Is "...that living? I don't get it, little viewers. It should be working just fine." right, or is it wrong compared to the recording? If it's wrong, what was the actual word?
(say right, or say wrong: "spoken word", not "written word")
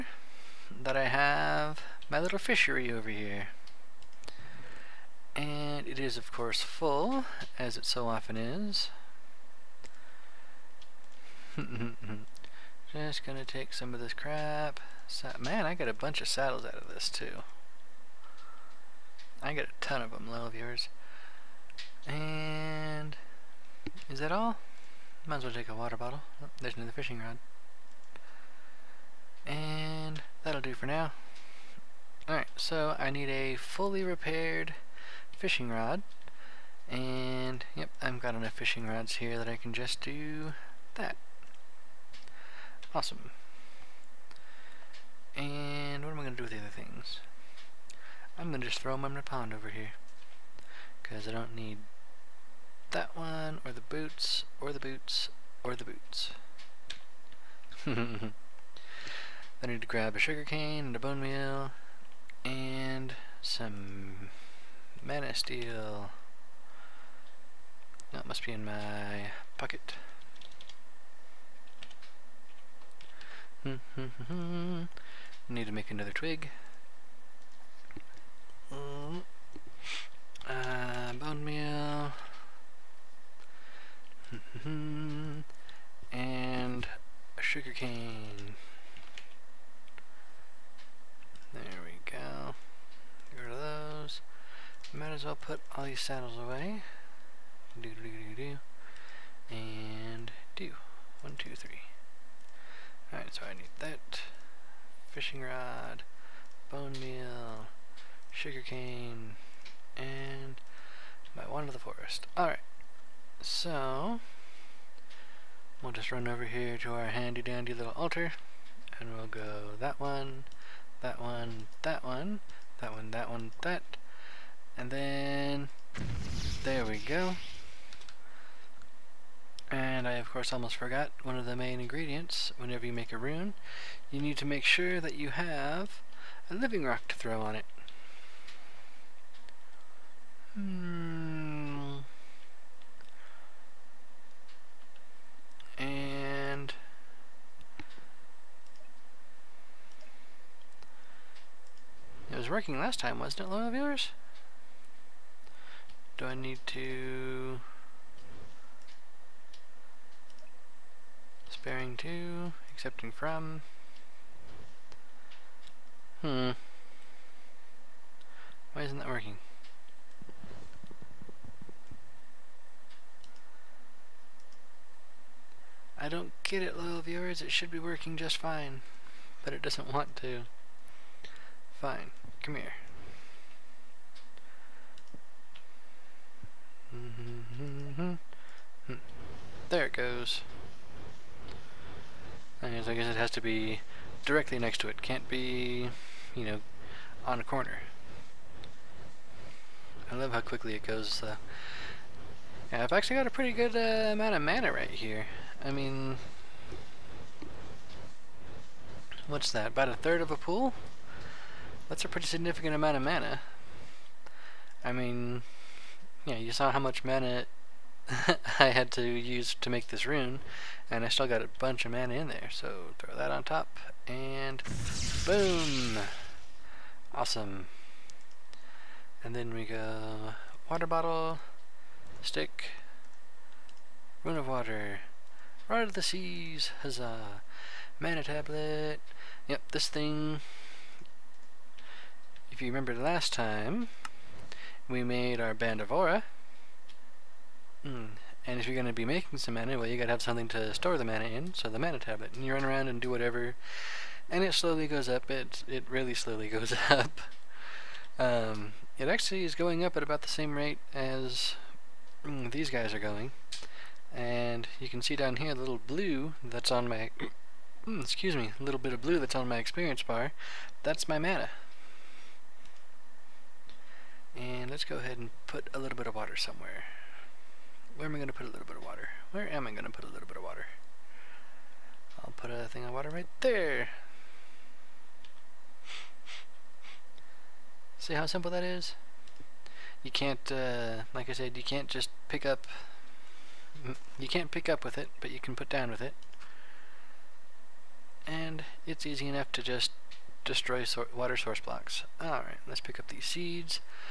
wrong: "working", not "living".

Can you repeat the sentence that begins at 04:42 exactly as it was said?
I'll put a thing of water right there.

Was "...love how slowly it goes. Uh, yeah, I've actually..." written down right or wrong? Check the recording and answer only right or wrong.
wrong.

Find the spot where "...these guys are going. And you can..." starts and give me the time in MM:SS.
04:22.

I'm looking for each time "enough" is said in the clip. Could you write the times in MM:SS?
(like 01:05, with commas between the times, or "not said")
00:38, 04:59.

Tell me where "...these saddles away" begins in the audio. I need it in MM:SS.
01:35.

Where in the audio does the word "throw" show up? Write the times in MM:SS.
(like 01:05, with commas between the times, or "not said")
00:48, 02:17, 03:42.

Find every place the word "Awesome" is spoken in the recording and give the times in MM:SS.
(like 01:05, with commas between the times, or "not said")
00:42, 03:47.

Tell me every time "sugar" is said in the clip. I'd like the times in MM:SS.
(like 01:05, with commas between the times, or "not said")
01:00, 01:27, 01:48.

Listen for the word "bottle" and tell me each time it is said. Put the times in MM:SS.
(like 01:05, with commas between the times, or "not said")
00:25, 03:50.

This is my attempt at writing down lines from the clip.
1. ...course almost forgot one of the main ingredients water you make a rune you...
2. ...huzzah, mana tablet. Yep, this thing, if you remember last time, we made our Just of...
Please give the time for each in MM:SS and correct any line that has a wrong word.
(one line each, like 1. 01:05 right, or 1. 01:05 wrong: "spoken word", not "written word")
1. 02:10 wrong: "whenever", not "water"
2. 03:56 wrong: "Band", not "Just".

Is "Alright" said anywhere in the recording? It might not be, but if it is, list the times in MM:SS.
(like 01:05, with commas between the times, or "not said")
00:32, 01:43, 01:52, 05:02.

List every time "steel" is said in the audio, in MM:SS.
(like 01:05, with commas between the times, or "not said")
01:05.